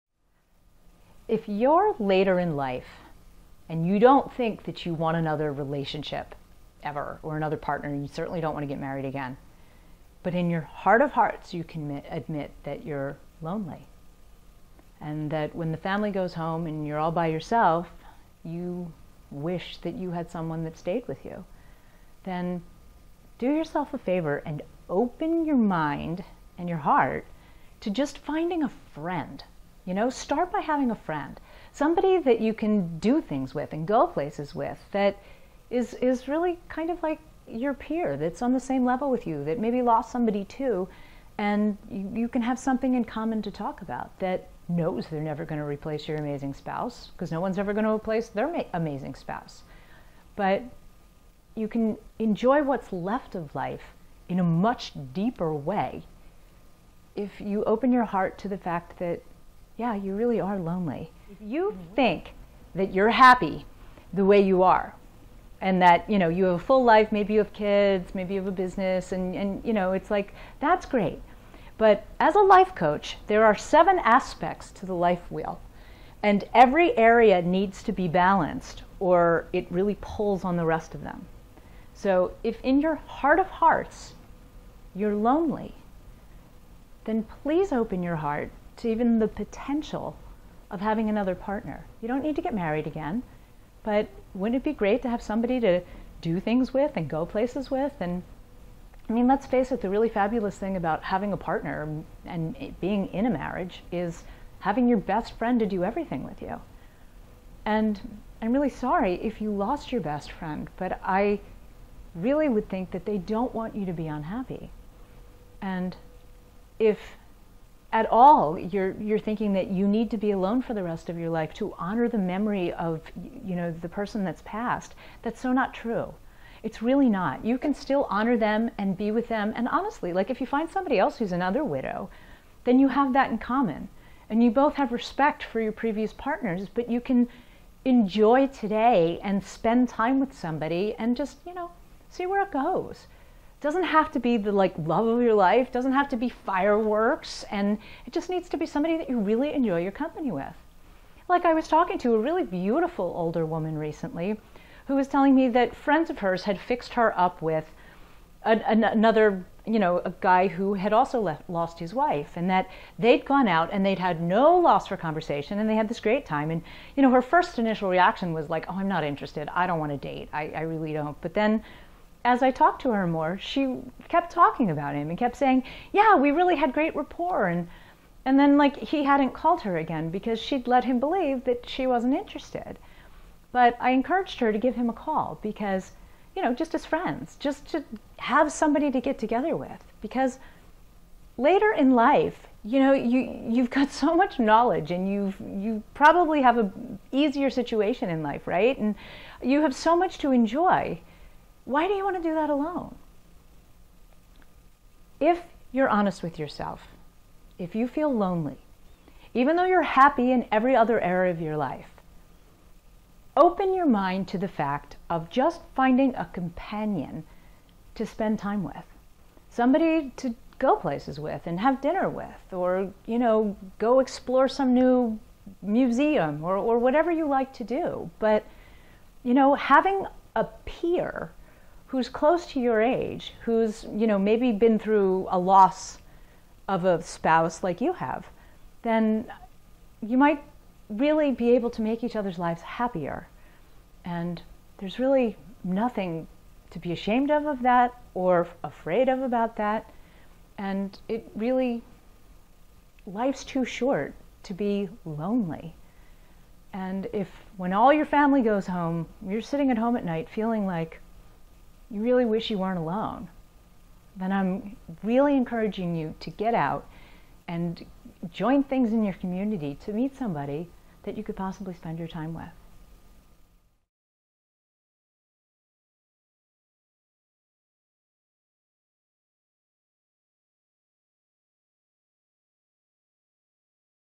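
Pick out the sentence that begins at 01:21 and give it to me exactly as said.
So if in your heart of hearts you're lonely, then please open your heart to even the potential of having another partner.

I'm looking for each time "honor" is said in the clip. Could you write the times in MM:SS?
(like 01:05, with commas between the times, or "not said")
02:01, 02:08.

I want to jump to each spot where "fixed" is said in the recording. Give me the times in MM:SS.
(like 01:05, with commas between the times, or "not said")
02:36.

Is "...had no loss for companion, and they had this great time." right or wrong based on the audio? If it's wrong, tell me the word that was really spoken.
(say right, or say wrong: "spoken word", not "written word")
wrong: "conversation", not "companion".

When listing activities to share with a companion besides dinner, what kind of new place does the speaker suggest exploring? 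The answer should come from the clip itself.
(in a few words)
Museum.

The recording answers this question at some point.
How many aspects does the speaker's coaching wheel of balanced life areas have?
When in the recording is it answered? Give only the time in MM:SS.
01:13.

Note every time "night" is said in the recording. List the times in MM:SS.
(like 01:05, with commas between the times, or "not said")
04:20.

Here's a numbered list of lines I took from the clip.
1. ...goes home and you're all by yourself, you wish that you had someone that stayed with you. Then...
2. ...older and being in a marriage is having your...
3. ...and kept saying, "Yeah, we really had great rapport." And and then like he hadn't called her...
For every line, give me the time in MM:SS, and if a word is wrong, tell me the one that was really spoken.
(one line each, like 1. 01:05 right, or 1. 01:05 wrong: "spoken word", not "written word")
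1. 00:16 right
2. 01:41 wrong: "partner", not "older"
3. 02:55 right.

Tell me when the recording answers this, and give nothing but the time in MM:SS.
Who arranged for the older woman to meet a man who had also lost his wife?
02:35.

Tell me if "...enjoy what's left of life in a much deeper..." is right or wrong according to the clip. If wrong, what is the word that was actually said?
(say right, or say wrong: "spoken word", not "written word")
right.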